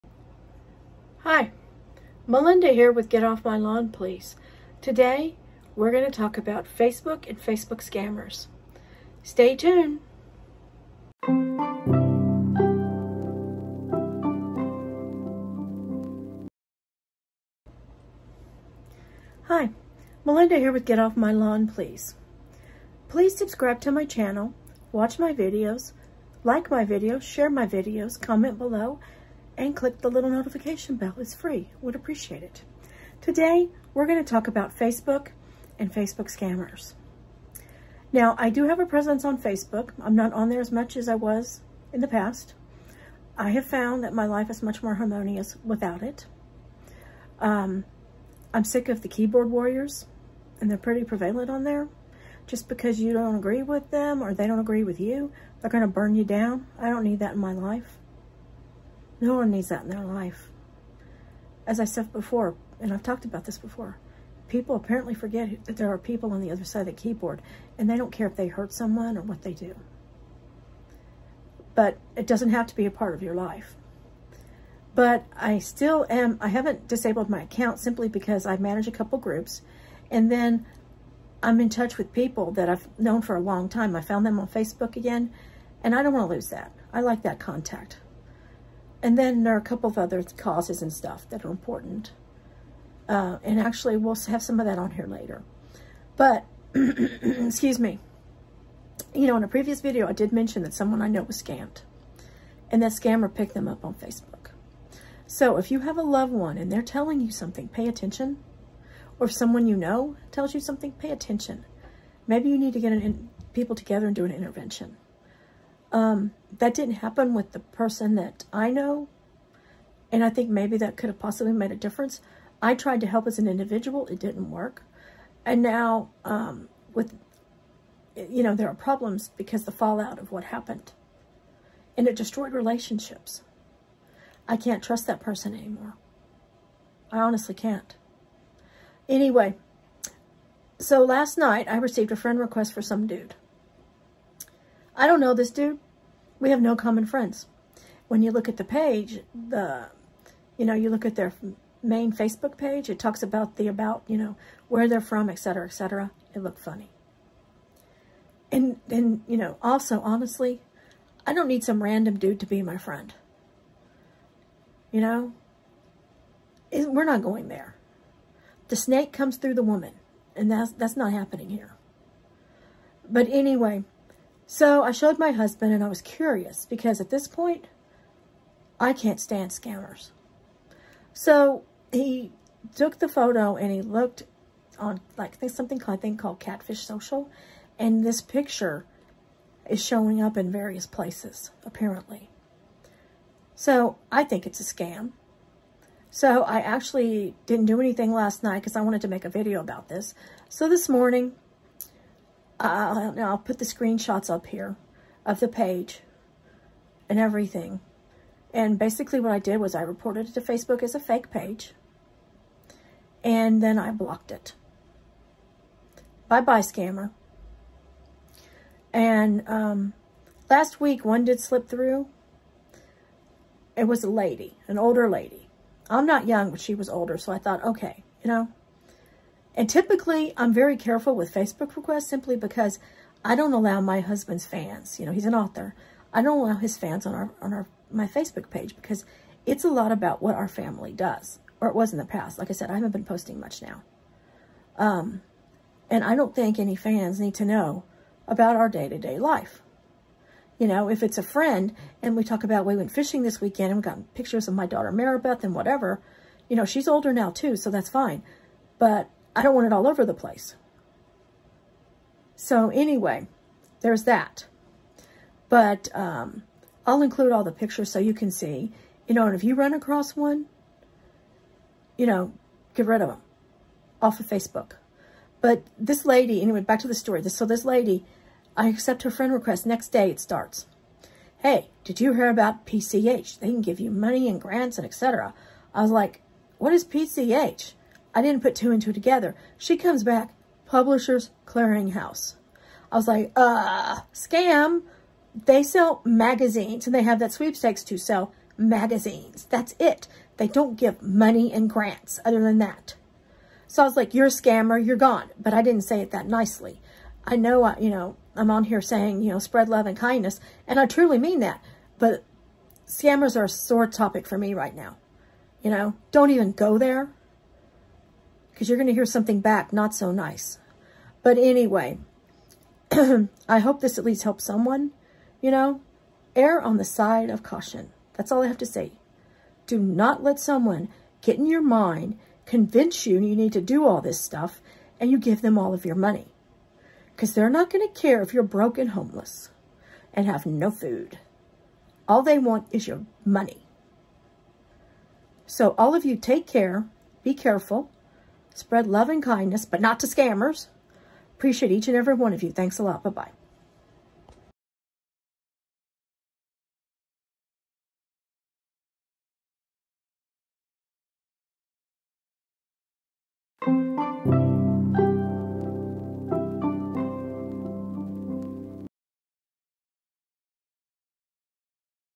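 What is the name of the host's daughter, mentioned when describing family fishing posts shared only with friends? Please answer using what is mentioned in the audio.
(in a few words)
Maribeth.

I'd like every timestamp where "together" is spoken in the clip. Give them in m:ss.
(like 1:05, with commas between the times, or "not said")
1:53, 4:48.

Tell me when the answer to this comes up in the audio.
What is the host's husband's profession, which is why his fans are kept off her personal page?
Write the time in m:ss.
3:55.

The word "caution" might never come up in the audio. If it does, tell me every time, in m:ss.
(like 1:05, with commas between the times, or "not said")
5:27.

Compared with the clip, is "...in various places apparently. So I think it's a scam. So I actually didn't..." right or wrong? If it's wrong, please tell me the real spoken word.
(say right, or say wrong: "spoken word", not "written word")
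right.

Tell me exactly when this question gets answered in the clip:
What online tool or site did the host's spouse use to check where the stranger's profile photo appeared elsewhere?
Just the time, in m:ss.
3:06.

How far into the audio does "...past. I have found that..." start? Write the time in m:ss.
0:42.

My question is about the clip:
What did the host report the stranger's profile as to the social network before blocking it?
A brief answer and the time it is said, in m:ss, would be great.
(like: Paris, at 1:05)
fake page, at 3:30.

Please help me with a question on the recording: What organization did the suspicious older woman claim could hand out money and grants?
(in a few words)
Publishers Clearinghouse.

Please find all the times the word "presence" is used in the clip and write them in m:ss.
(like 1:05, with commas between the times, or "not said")
0:38.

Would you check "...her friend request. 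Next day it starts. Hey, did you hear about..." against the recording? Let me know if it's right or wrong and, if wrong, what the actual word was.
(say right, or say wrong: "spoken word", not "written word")
right.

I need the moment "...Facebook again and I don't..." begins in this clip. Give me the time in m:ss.
1:24.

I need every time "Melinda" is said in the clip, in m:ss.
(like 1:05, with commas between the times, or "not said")
0:02, 0:20.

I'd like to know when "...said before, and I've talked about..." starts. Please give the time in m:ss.
1:01.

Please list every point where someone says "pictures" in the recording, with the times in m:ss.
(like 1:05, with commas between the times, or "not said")
3:08, 4:14, 4:27.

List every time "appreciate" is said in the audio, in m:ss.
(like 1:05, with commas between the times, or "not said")
0:31, 5:51.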